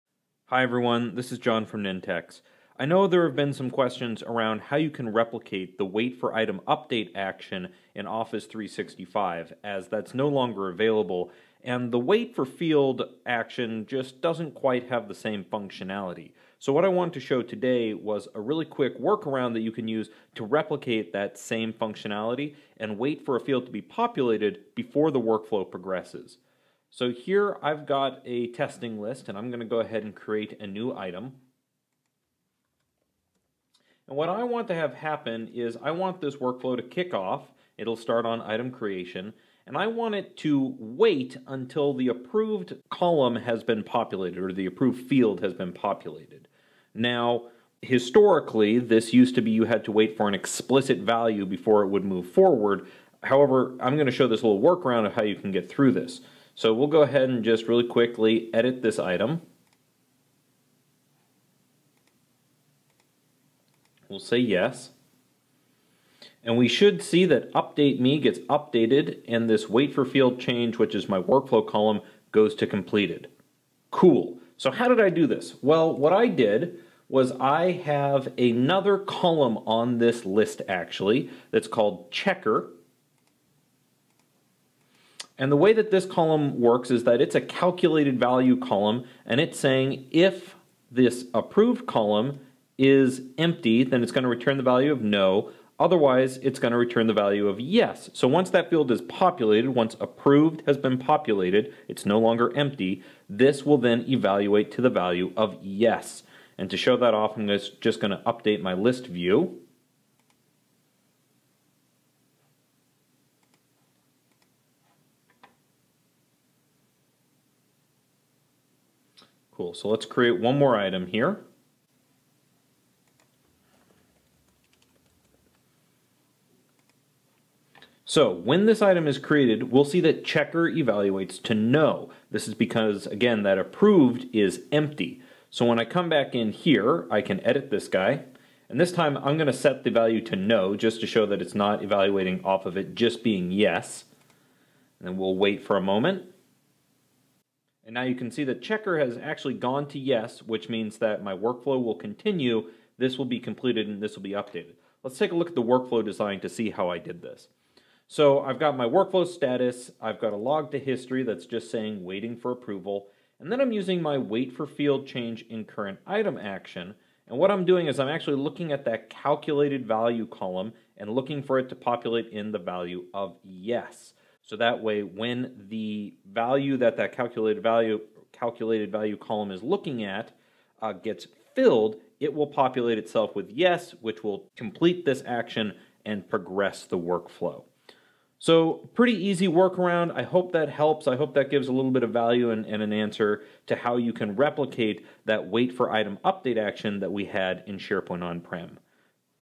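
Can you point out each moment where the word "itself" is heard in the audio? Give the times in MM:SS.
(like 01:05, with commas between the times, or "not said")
03:02.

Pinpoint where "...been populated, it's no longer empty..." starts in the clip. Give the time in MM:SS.
01:40.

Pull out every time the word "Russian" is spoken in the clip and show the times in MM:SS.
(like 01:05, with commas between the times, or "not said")
not said.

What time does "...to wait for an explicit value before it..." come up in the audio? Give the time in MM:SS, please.
00:49.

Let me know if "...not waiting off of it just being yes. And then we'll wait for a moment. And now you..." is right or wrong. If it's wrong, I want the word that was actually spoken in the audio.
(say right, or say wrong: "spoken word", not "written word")
wrong: "evaluating", not "waiting".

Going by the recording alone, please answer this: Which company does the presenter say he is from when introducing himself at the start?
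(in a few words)
Nintex.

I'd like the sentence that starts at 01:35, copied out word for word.
Otherwise, it's going to return the value of yes.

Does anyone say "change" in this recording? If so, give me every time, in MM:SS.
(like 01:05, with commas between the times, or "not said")
01:10, 02:45.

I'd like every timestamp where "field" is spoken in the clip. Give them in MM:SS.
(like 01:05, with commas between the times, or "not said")
00:12, 00:23, 00:45, 01:10, 01:38, 02:44.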